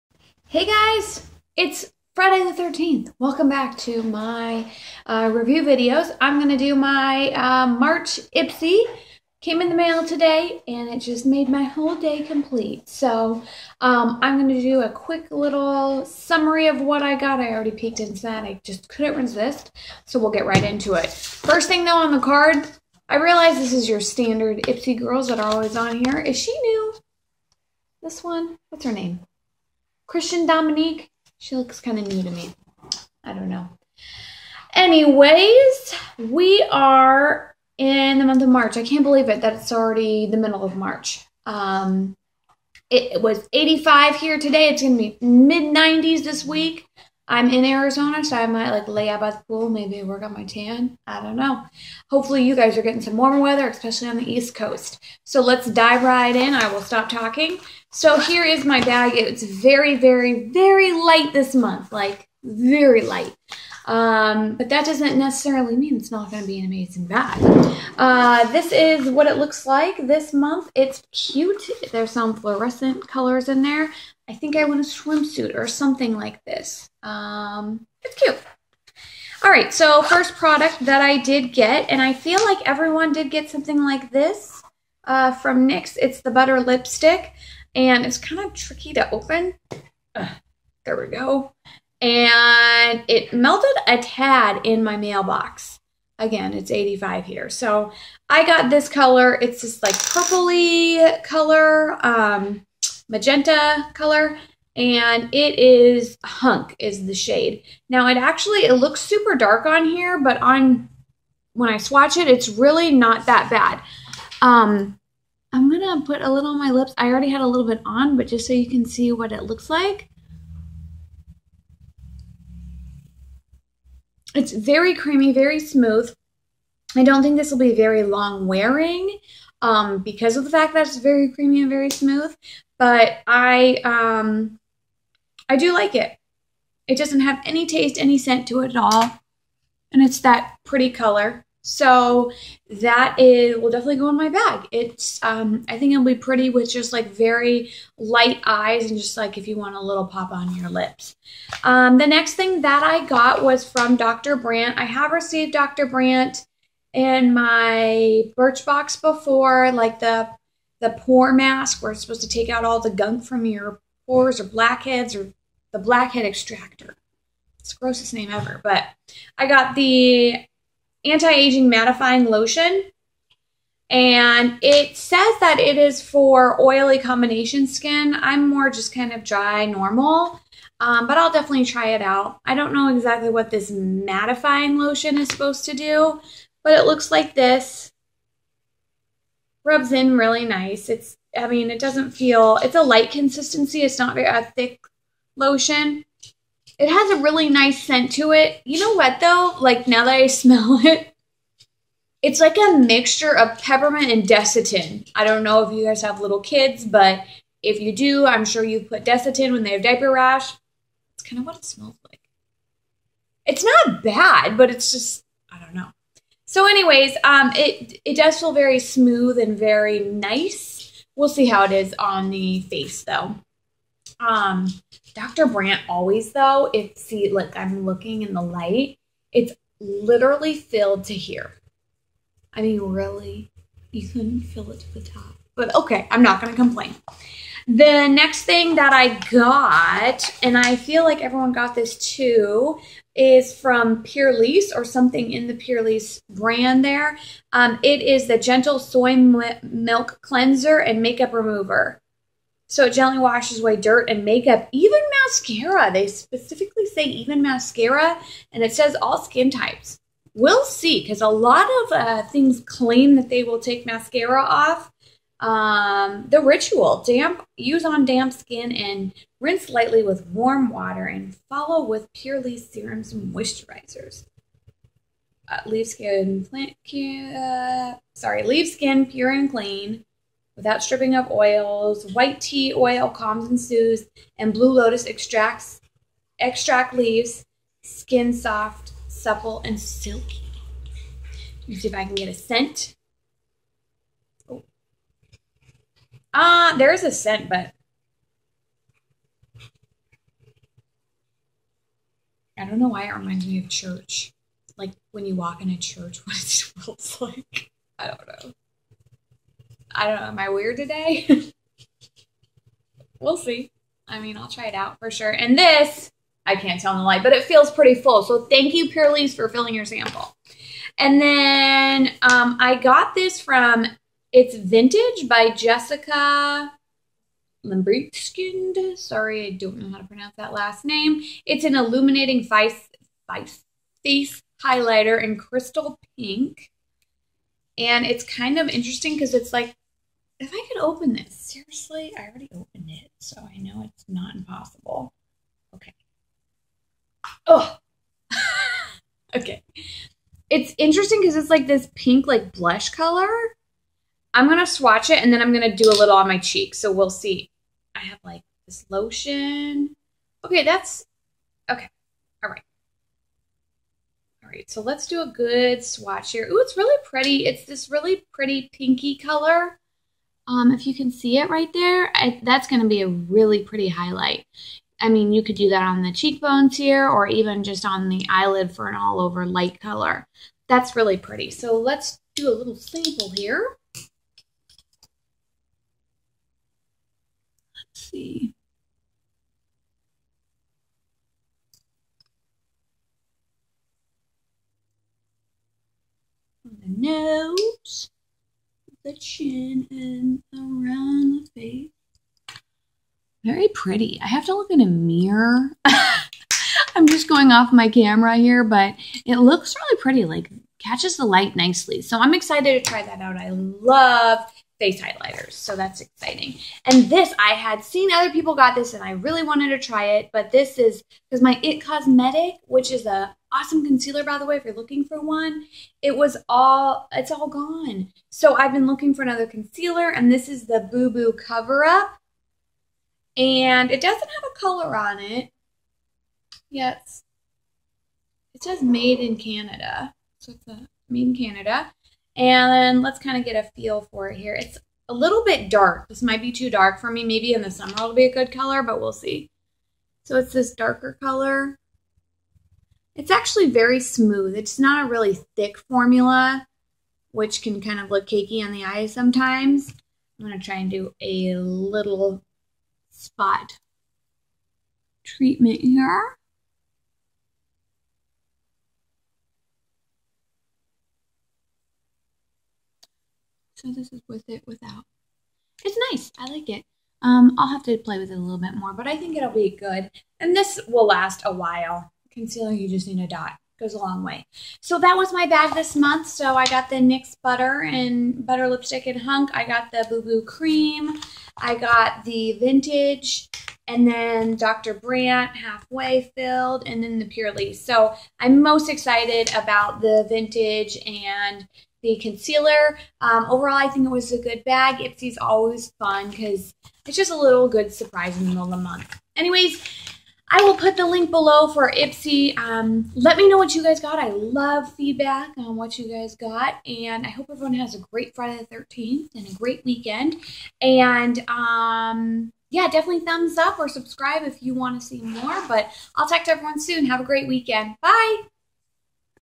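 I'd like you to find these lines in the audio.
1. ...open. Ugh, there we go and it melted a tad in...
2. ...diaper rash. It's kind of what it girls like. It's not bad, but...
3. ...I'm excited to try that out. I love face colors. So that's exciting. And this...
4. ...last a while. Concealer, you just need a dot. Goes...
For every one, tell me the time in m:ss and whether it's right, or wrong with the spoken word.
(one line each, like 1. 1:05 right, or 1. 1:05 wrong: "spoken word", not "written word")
1. 1:29 right
2. 3:29 wrong: "smells", not "girls"
3. 6:52 wrong: "highlighters", not "colors"
4. 8:01 right.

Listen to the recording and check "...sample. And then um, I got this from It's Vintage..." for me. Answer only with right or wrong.
right.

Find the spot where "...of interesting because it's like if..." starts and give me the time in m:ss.
5:38.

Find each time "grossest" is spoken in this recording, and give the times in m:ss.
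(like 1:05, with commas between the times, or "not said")
2:47.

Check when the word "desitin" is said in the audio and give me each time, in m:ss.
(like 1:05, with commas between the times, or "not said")
3:24, 3:29.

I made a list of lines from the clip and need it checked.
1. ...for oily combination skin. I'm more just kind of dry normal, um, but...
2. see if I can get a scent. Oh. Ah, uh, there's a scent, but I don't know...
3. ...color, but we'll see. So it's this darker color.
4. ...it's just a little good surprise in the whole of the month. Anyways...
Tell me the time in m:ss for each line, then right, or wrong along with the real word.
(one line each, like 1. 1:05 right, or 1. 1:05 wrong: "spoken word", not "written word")
1. 2:56 right
2. 4:51 right
3. 7:28 right
4. 8:27 wrong: "middle", not "whole".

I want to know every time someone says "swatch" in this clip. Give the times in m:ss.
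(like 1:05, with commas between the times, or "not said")
1:51, 5:54, 6:05.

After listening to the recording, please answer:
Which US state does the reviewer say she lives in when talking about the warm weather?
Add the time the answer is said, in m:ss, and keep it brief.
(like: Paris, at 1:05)
Arizona, at 0:47.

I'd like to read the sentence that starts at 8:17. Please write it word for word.
So I'm most excited about the vintage and the concealer.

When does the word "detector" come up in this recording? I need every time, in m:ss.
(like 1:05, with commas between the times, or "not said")
not said.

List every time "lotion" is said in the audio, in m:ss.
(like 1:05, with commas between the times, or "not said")
2:52, 3:04, 3:15, 5:58.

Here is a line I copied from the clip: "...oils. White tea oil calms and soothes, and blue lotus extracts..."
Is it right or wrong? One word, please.
right.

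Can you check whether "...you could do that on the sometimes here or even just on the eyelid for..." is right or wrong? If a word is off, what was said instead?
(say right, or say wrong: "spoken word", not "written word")
wrong: "cheekbones", not "sometimes".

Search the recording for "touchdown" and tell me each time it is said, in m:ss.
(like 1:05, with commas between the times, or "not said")
not said.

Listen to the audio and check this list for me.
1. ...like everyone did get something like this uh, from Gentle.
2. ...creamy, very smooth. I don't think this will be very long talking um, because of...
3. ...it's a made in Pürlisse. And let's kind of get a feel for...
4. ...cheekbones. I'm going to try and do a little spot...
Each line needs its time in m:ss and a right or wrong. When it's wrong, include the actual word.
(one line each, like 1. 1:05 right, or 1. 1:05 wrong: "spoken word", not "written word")
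1. 1:22 wrong: "NYX", not "Gentle"
2. 2:04 wrong: "wearing", not "talking"
3. 7:20 wrong: "Canada", not "Pürlisse"
4. 7:39 wrong: "sometimes", not "cheekbones".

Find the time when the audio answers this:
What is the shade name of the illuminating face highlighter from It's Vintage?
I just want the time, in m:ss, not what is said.
5:35.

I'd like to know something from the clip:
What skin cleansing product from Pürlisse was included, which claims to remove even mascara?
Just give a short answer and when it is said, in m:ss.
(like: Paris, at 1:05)
Gentle Soy Milk Cleanser, at 4:08.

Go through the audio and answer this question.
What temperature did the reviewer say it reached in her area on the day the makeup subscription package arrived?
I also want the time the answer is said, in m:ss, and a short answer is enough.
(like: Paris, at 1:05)
85, at 0:42.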